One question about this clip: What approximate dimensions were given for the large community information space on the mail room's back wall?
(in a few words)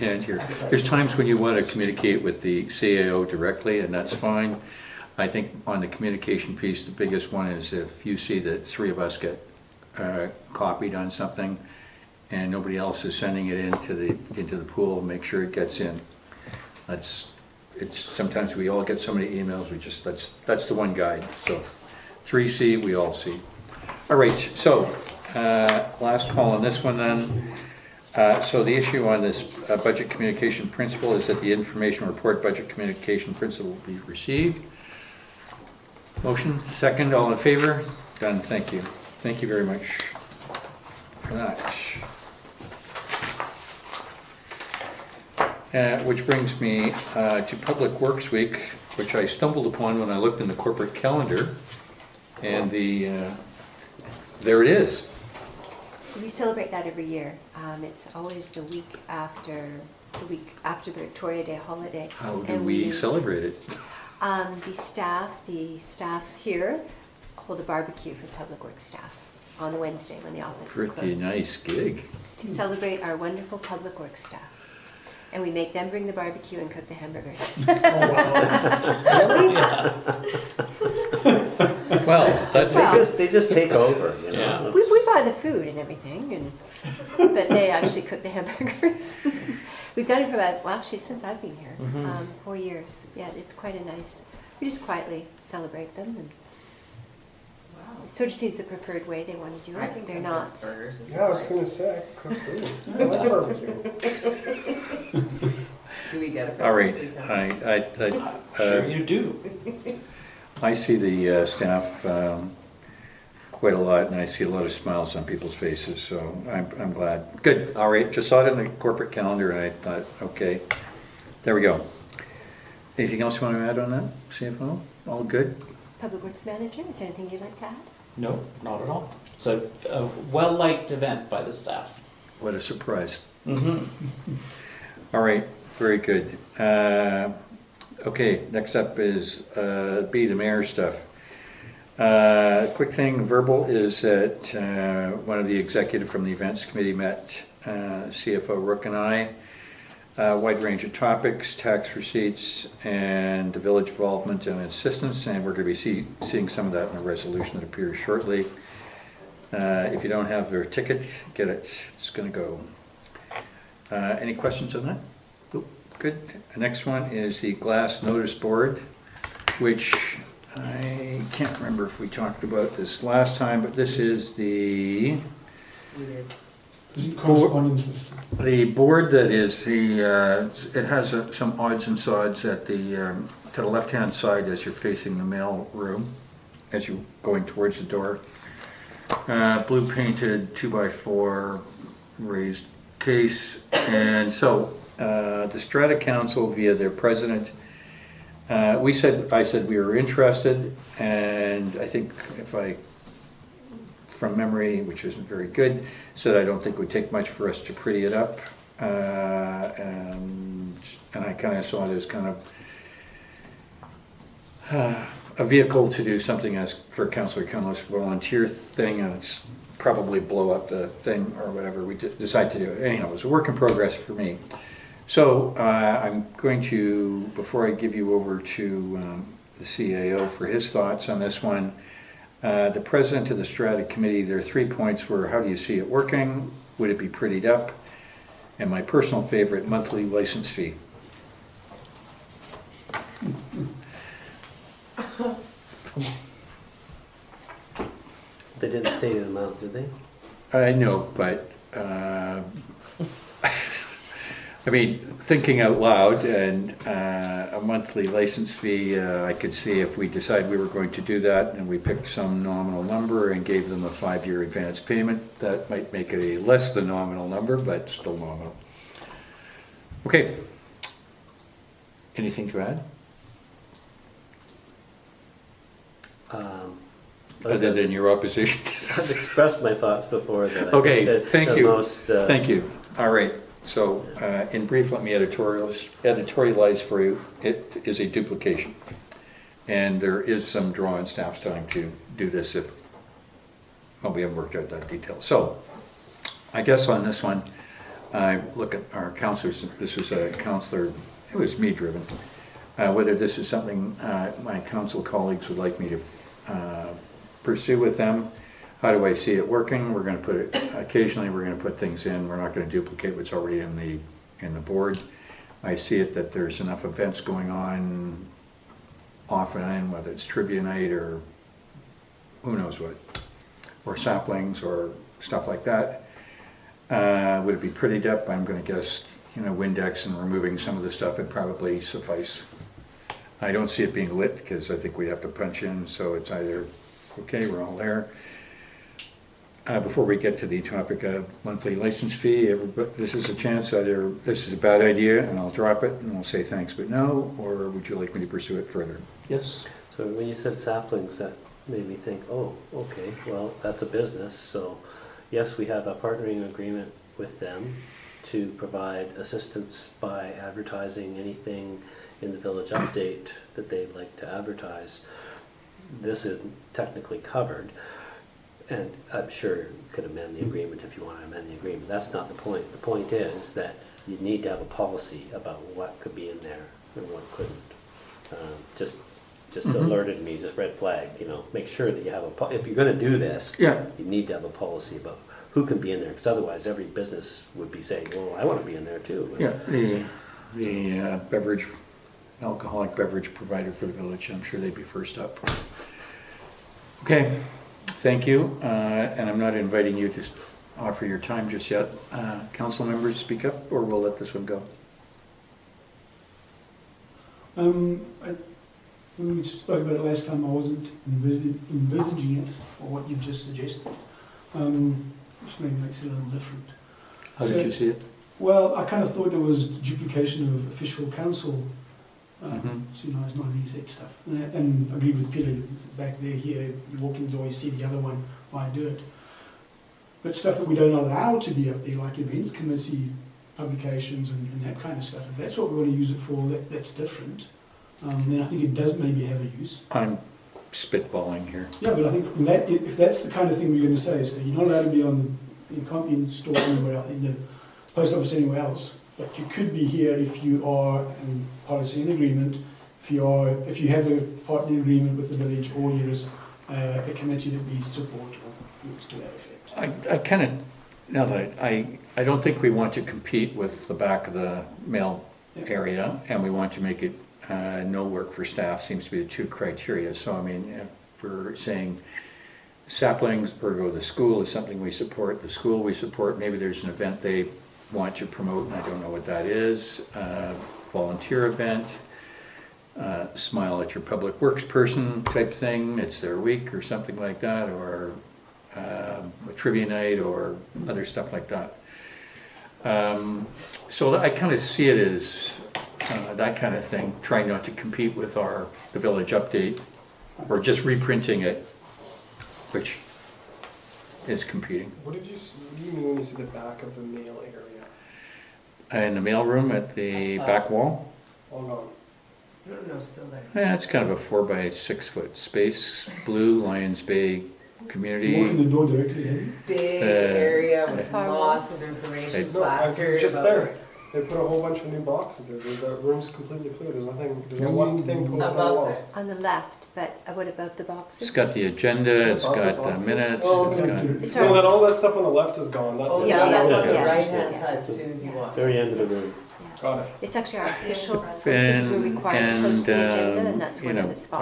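4 by 6 feet.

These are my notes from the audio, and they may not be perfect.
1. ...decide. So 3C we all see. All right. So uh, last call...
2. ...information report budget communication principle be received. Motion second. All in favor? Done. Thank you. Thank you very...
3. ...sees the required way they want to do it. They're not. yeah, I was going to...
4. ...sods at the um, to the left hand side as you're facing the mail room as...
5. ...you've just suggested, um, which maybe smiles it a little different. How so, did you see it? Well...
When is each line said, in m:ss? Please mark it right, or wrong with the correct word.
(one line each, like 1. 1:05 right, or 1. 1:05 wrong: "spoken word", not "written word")
1. 0:20 wrong: "guide", not "decide"
2. 0:31 right
3. 1:38 wrong: "preferred", not "required"
4. 3:01 right
5. 6:53 wrong: "makes", not "smiles".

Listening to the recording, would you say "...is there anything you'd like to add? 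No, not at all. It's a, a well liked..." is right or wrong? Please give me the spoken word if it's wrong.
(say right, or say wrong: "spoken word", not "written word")
right.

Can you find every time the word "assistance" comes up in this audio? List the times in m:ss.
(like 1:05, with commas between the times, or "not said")
2:34, 5:59.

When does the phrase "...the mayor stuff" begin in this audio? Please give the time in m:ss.
2:20.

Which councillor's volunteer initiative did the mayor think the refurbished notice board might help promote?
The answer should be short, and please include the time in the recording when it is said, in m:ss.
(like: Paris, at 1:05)
Councilor Cunliffe, at 3:37.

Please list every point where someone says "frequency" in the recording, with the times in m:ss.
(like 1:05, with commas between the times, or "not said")
not said.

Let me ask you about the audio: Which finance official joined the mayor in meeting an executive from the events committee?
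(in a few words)
CFO Rook.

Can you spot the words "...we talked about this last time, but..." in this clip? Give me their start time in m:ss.
2:51.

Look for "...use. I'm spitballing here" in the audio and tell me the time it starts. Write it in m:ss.
7:19.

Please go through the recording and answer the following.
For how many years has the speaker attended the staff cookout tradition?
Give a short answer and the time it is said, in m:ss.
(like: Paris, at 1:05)
4 years, at 1:32.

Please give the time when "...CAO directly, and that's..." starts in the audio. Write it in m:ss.
0:02.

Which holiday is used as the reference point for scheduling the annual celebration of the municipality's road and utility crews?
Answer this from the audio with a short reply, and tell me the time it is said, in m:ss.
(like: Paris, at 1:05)
Victoria Day, at 1:01.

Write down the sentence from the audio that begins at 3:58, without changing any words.
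And my personal favorite, monthly license fee.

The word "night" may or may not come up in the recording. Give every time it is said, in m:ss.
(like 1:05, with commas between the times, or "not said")
5:20, 8:09.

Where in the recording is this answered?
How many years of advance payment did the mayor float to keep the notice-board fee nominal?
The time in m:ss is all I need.
4:23.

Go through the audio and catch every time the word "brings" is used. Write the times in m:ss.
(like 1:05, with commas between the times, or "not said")
0:46, 1:15.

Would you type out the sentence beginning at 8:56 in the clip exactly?
yeah, that's on the right hand side as soon as you walk.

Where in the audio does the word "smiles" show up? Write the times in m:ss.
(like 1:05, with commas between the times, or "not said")
1:54, 8:03.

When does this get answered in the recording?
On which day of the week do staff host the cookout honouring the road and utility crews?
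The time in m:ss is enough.
1:09.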